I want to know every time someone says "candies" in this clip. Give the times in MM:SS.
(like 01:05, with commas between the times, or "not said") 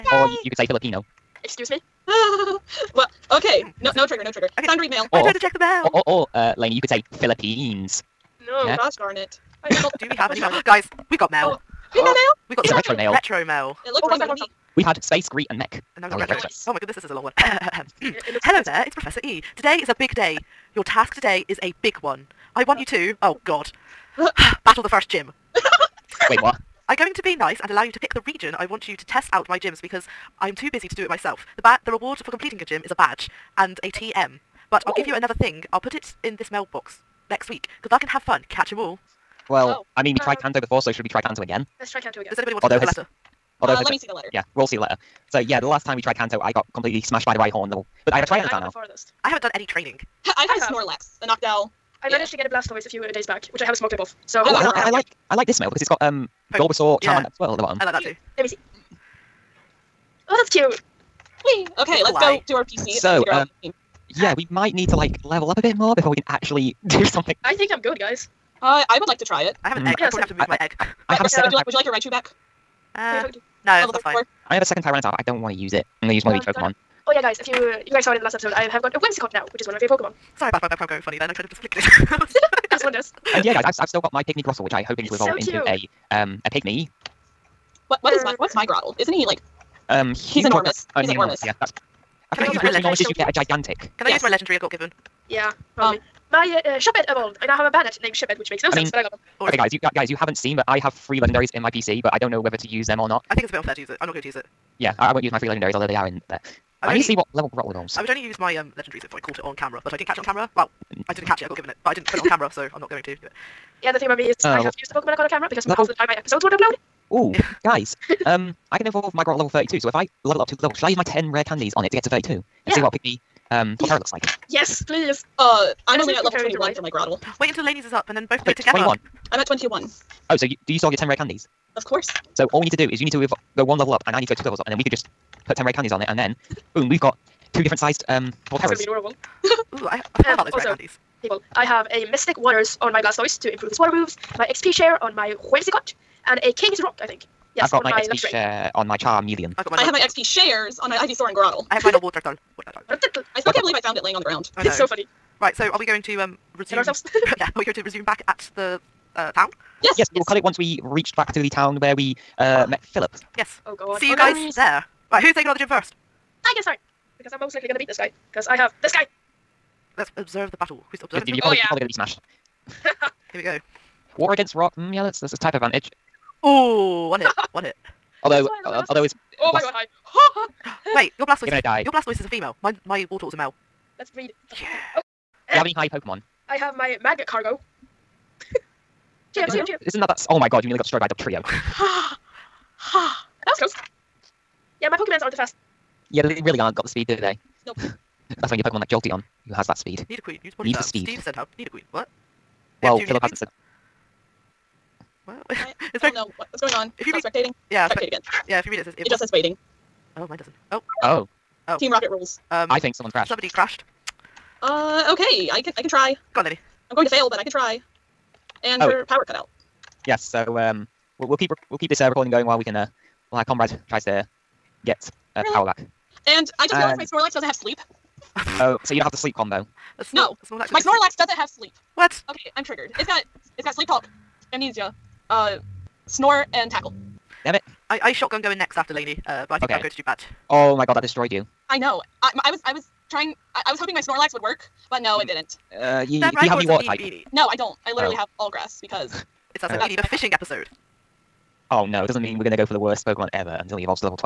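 02:01, 02:11, 02:15, 02:20.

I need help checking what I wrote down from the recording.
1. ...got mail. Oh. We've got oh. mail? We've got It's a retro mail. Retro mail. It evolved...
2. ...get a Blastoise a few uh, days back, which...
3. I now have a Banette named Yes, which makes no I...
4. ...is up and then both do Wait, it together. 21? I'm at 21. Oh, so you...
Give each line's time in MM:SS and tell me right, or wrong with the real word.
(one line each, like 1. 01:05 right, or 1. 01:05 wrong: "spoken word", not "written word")
1. 00:11 wrong: "looked", not "evolved"
2. 00:52 right
3. 01:37 wrong: "Shepherd", not "Yes"
4. 02:07 right.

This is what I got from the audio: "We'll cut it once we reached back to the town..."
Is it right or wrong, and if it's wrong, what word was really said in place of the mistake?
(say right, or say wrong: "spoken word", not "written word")
right.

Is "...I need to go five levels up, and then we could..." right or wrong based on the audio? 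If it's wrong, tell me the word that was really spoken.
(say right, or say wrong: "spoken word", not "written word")
wrong: "two", not "five".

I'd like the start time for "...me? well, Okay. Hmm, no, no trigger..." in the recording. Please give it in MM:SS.
00:01.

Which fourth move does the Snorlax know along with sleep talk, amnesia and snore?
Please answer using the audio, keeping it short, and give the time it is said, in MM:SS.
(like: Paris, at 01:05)
Tackle, at 03:56.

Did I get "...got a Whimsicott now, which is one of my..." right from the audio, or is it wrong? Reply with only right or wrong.
right.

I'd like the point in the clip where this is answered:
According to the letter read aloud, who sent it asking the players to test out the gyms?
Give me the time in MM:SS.
00:18.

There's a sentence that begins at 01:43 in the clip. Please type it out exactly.
I think it's a bit unfair to use it.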